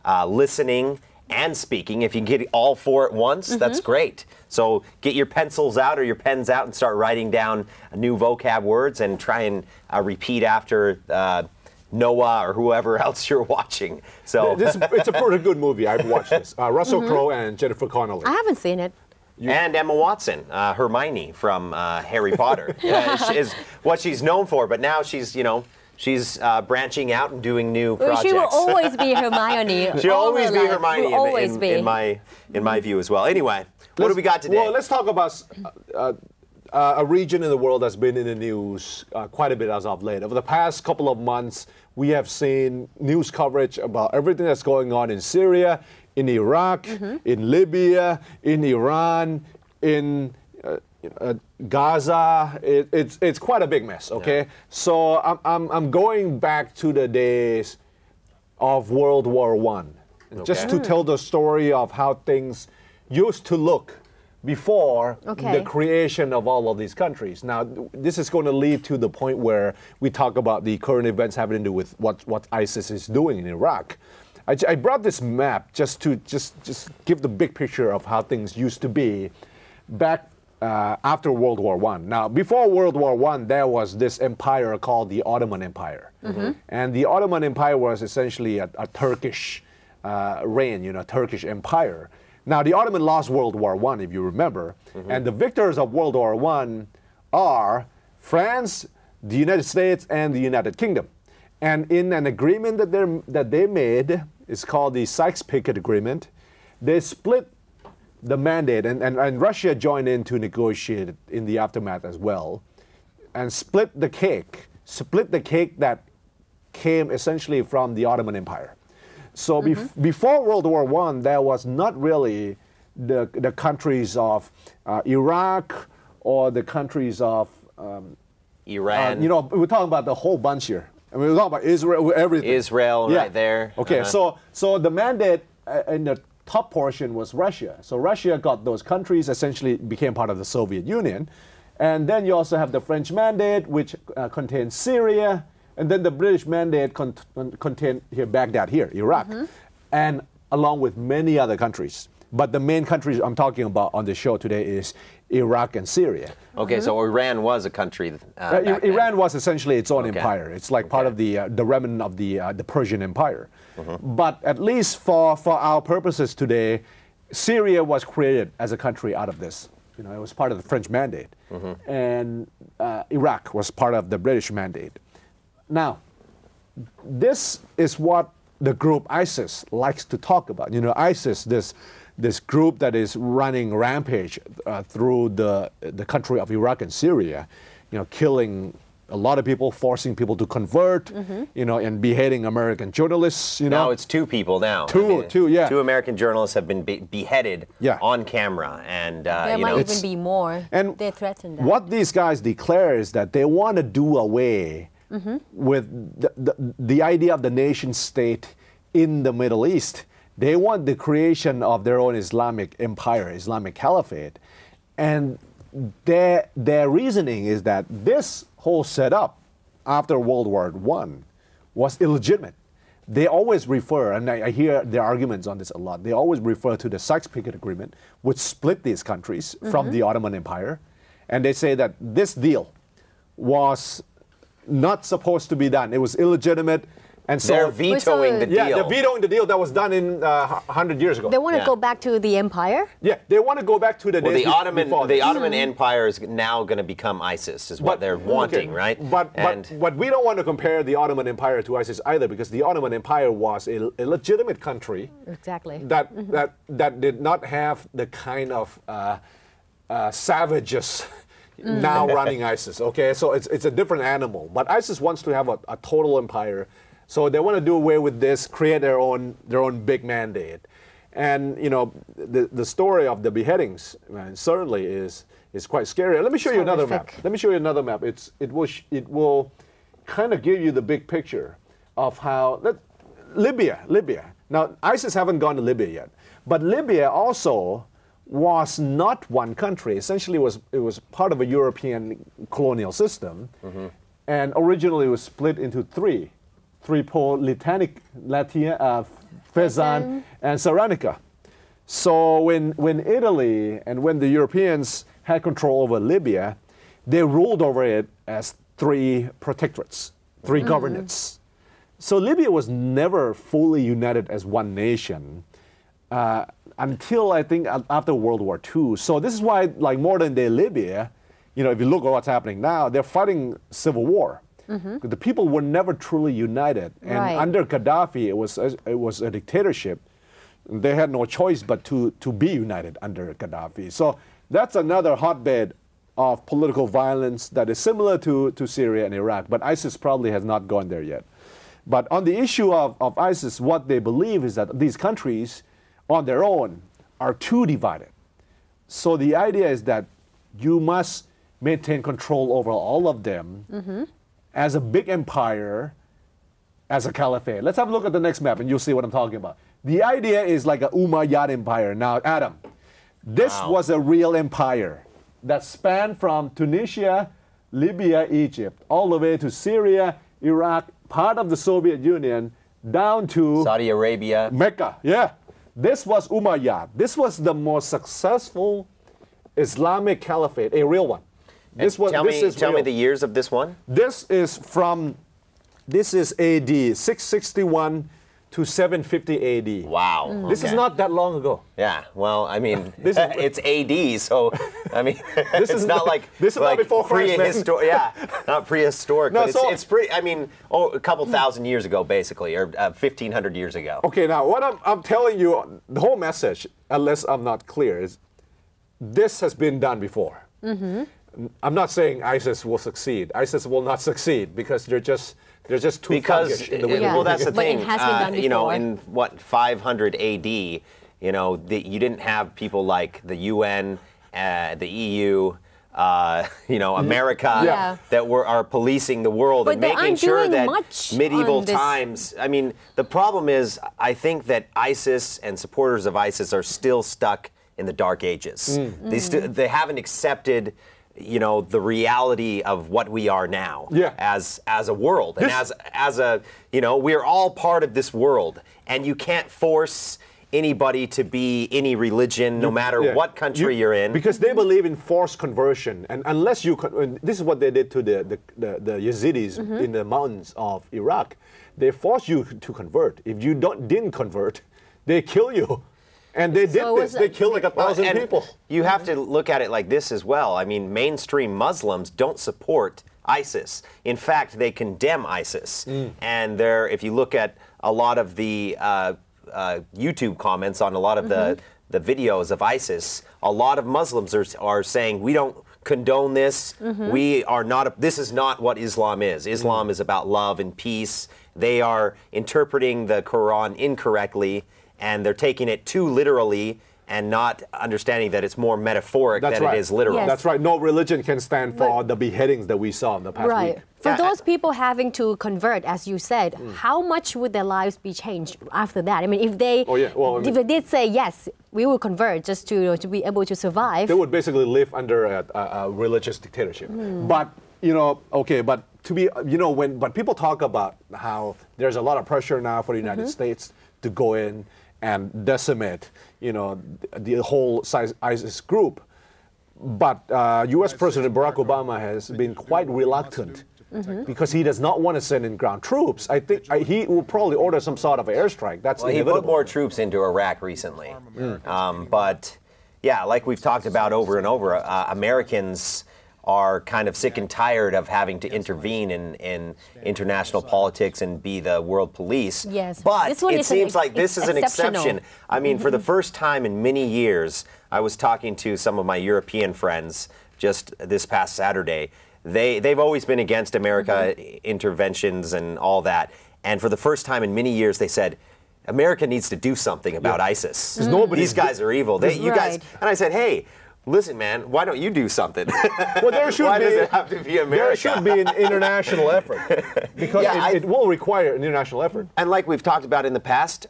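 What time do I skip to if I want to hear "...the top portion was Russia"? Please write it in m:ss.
2:16.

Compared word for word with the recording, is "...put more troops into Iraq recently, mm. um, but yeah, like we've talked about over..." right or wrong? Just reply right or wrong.
right.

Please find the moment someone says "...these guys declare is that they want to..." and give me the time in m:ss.
3:21.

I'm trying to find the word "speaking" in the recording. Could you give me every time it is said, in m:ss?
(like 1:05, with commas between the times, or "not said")
0:01.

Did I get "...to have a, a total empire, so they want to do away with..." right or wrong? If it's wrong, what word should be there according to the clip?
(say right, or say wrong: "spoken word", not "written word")
right.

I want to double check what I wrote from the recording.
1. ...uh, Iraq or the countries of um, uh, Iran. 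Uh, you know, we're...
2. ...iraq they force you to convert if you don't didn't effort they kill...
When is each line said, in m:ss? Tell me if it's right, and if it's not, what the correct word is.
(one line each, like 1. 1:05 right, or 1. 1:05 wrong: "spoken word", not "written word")
1. 2:04 right
2. 7:40 wrong: "convert", not "effort".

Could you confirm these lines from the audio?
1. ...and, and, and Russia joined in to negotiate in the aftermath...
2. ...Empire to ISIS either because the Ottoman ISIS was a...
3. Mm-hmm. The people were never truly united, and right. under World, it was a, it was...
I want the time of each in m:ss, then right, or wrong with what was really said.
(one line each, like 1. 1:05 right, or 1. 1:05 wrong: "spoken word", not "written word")
1. 1:48 right
2. 4:11 wrong: "Empire", not "ISIS"
3. 5:24 wrong: "Gaddafi", not "World".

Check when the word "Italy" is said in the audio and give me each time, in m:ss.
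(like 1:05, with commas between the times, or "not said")
5:03.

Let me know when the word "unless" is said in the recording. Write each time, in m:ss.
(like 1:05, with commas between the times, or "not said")
6:46, 7:36.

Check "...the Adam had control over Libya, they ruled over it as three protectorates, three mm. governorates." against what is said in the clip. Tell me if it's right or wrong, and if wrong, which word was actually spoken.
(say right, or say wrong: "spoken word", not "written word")
wrong: "Europeans", not "Adam".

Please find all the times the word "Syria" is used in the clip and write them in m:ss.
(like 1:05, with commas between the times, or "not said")
0:45, 2:24, 2:35, 2:47, 3:06, 5:38, 6:09.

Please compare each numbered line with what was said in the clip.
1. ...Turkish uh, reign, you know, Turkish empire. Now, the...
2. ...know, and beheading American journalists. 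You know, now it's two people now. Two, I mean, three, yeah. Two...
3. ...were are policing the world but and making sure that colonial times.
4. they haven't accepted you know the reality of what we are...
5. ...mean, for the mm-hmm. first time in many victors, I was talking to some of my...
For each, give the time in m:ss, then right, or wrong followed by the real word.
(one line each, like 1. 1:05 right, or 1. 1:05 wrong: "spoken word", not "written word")
1. 1:28 right
2. 3:11 wrong: "two", not "three"
3. 7:08 wrong: "medieval", not "colonial"
4. 7:19 right
5. 9:15 wrong: "years", not "victors".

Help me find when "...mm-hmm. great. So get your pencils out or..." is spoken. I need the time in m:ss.
0:03.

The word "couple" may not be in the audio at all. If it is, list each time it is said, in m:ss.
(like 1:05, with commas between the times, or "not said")
0:40, 6:41.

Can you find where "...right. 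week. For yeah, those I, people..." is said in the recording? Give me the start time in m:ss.
8:23.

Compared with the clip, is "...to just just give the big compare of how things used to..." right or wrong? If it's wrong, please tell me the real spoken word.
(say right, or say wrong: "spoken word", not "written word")
wrong: "picture", not "compare".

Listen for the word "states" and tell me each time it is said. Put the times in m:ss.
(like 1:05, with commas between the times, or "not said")
1:39, 3:27, 8:43.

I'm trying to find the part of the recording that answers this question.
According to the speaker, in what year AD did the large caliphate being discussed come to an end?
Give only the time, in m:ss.
6:28.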